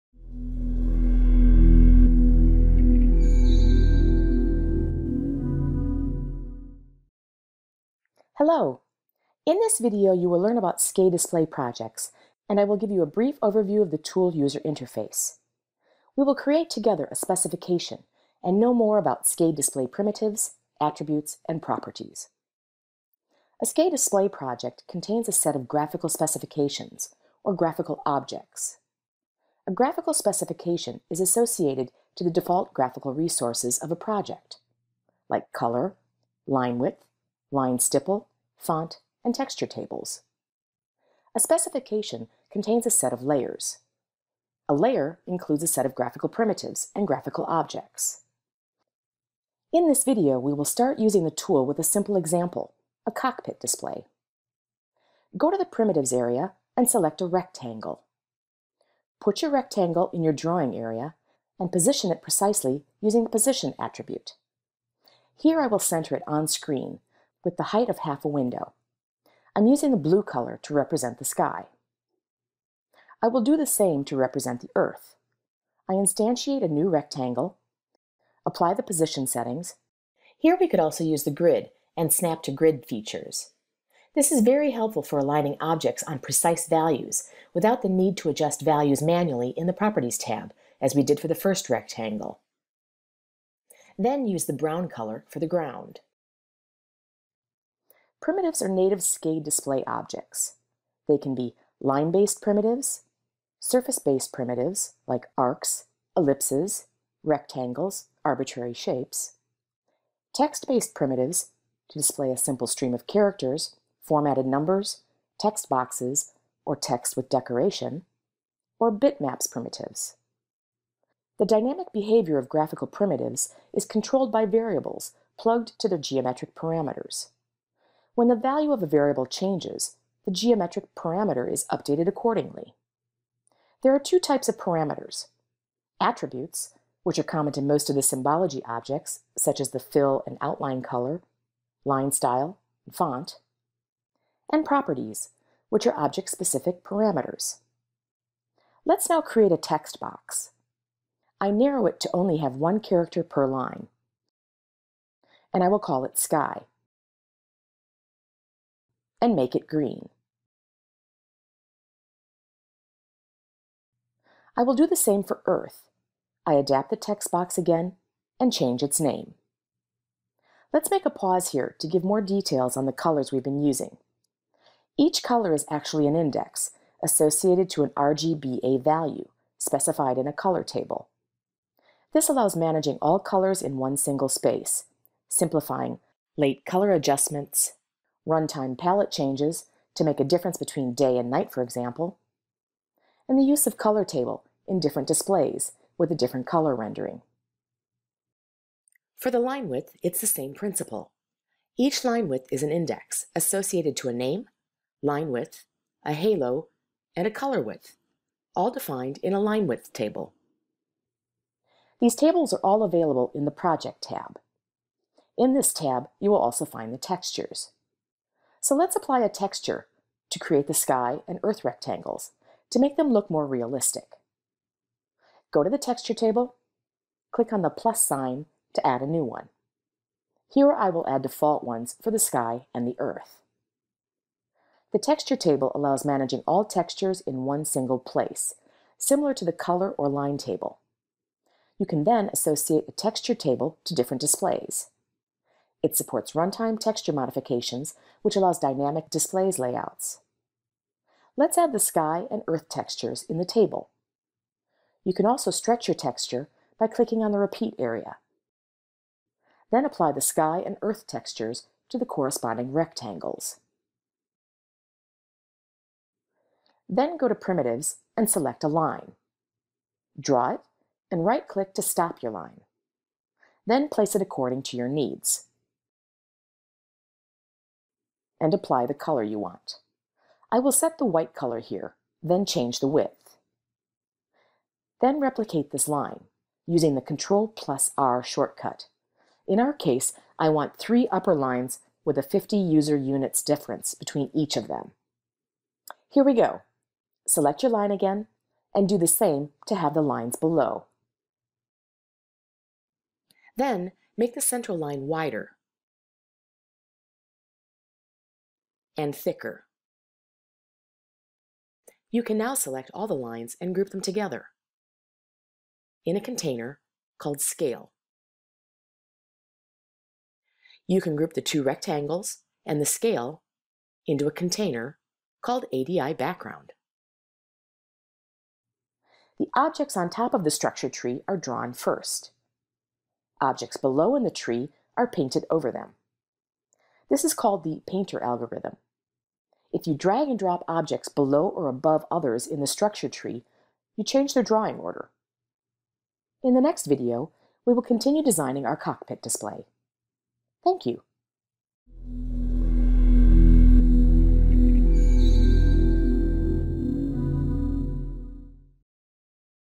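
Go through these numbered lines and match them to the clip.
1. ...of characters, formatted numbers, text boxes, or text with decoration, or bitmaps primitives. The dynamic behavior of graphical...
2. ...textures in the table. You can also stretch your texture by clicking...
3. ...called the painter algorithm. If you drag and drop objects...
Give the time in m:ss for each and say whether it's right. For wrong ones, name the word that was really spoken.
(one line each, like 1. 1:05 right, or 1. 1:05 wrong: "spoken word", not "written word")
1. 1:52 right
2. 4:12 right
3. 5:37 right.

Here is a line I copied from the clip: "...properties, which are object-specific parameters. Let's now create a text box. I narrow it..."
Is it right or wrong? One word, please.
right.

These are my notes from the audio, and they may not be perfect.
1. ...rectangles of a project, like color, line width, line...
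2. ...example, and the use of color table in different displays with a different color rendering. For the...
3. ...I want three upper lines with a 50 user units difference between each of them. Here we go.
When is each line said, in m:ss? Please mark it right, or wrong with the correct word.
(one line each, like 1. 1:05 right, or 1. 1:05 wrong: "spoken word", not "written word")
1. 0:33 wrong: "resources", not "rectangles"
2. 3:11 right
3. 4:50 right.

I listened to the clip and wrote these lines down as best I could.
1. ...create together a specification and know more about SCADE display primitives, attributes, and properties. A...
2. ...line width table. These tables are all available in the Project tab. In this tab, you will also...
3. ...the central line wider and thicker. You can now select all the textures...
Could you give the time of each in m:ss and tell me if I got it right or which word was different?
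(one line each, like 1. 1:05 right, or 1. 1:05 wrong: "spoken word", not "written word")
1. 0:16 right
2. 3:29 right
3. 5:04 wrong: "lines", not "textures".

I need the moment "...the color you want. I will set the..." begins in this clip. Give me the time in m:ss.
4:38.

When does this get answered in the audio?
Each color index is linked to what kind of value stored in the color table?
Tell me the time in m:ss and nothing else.
2:57.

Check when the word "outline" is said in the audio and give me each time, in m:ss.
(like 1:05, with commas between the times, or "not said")
2:20.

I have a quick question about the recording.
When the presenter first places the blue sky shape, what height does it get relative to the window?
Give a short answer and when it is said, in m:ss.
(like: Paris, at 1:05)
Half a window, at 1:07.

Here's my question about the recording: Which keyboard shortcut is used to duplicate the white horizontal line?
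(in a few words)
Control plus R.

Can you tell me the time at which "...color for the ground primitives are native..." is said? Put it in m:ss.
1:34.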